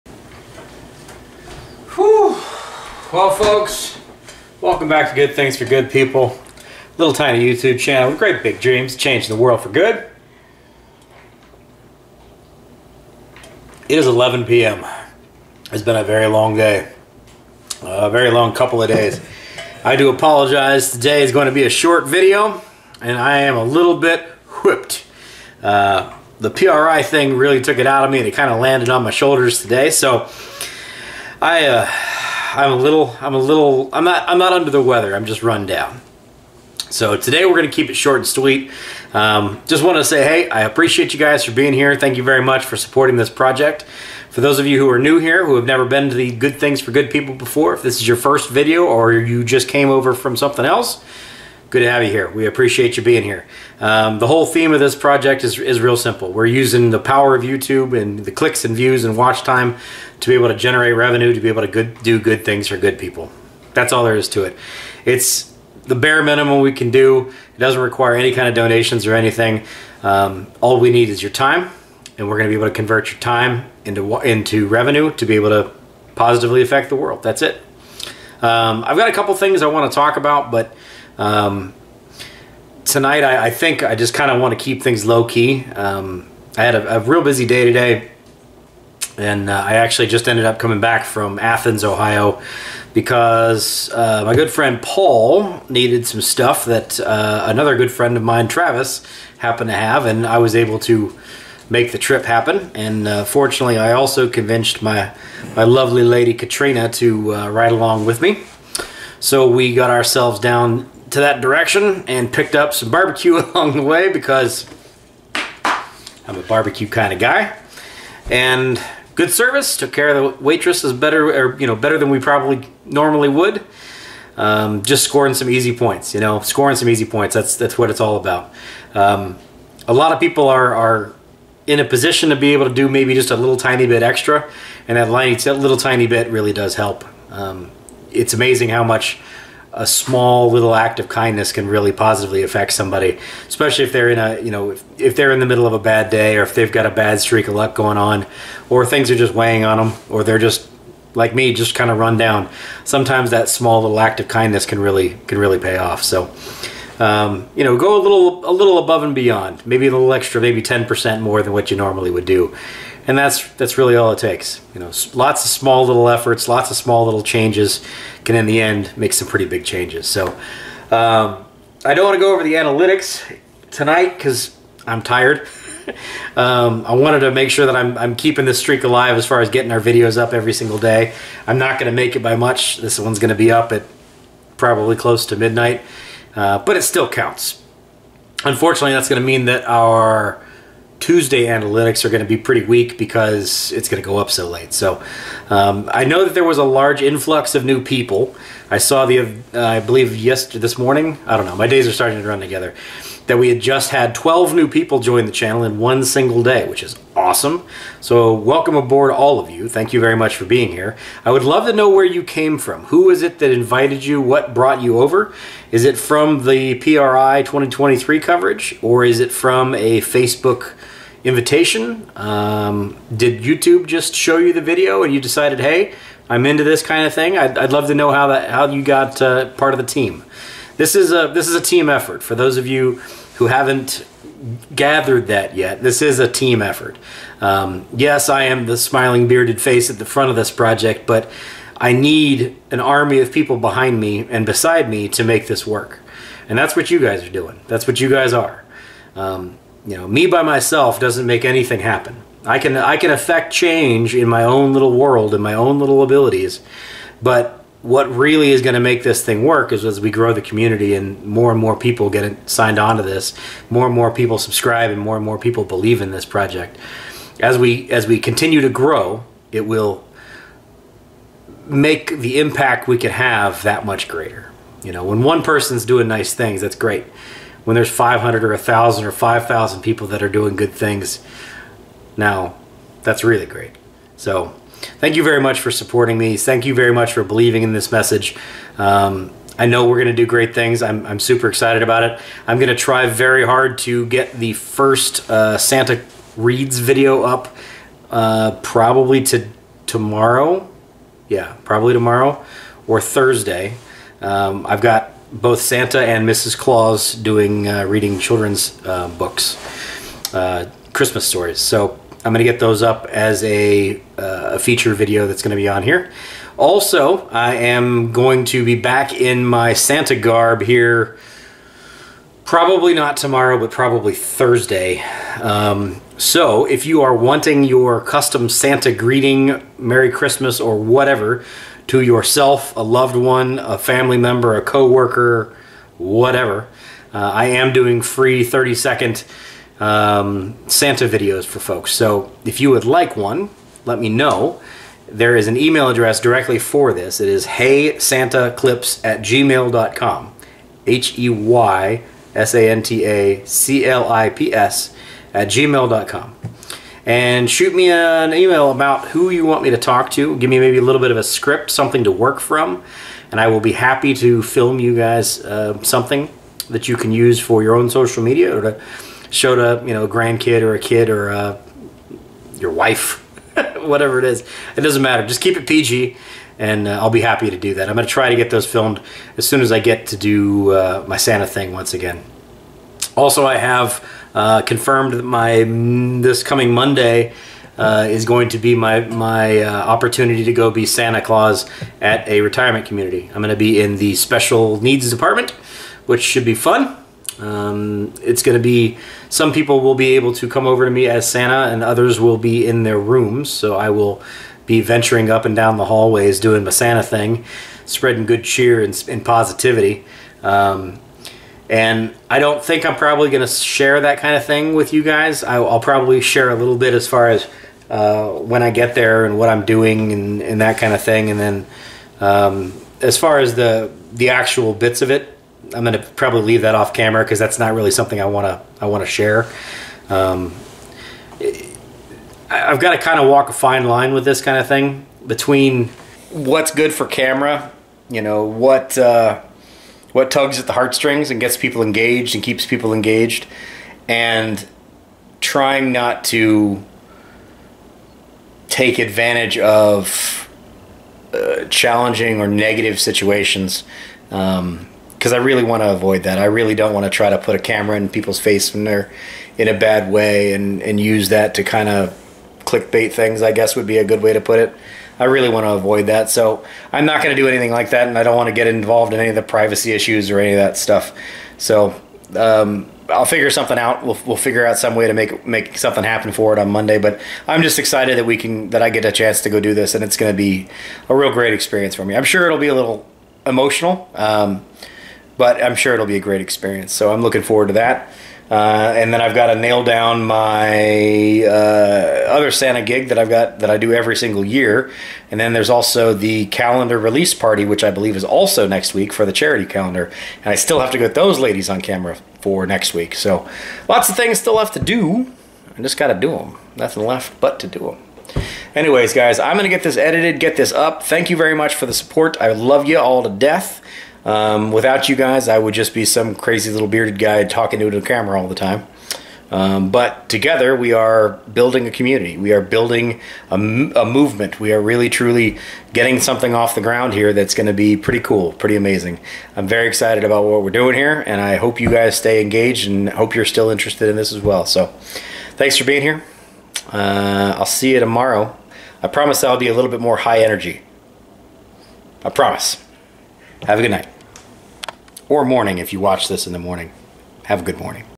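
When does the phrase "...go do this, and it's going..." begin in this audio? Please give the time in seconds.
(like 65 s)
479 s.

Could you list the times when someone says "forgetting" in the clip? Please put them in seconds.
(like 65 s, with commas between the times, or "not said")
not said.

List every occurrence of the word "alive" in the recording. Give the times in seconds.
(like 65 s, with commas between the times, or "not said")
178 s.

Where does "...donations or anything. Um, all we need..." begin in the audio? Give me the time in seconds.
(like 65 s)
68 s.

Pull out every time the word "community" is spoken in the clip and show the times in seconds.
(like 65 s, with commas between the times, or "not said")
260 s, 392 s, 521 s.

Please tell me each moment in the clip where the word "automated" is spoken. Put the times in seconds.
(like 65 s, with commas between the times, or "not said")
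not said.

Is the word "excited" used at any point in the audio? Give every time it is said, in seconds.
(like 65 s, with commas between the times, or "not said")
291 s, 477 s, 529 s.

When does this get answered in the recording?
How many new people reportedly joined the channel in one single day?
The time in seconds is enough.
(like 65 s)
204 s.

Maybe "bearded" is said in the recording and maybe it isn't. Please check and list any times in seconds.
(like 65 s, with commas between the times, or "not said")
239 s, 516 s.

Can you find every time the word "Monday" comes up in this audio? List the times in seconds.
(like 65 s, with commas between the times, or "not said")
386 s, 476 s.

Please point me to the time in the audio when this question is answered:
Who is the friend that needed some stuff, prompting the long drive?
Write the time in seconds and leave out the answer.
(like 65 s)
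94 s.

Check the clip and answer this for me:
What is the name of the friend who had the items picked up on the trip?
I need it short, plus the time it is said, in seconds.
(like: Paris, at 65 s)
Travis, at 98 s.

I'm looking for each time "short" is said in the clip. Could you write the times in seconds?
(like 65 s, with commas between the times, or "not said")
21 s, 37 s.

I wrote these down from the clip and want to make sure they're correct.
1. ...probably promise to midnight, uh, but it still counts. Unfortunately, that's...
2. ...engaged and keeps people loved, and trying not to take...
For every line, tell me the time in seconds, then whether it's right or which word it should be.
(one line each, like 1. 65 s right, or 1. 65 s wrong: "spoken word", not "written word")
1. 184 s wrong: "close", not "promise"
2. 441 s wrong: "engaged", not "loved".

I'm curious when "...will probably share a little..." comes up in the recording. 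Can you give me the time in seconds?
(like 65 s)
415 s.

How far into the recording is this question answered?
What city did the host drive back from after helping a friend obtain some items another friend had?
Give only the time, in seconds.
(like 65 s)
91 s.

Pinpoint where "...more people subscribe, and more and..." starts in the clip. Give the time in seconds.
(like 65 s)
263 s.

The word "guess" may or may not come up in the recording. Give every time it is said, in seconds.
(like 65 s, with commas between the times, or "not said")
463 s.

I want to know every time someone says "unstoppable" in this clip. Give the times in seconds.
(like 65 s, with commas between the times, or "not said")
not said.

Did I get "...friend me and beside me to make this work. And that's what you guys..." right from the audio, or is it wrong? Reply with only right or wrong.
wrong.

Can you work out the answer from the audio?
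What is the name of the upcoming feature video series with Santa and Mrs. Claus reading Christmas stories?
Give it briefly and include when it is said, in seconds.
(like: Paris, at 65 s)
Santa Reads, at 295 s.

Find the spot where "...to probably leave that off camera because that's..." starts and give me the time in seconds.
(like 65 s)
425 s.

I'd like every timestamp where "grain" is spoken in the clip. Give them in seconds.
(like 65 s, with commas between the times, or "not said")
not said.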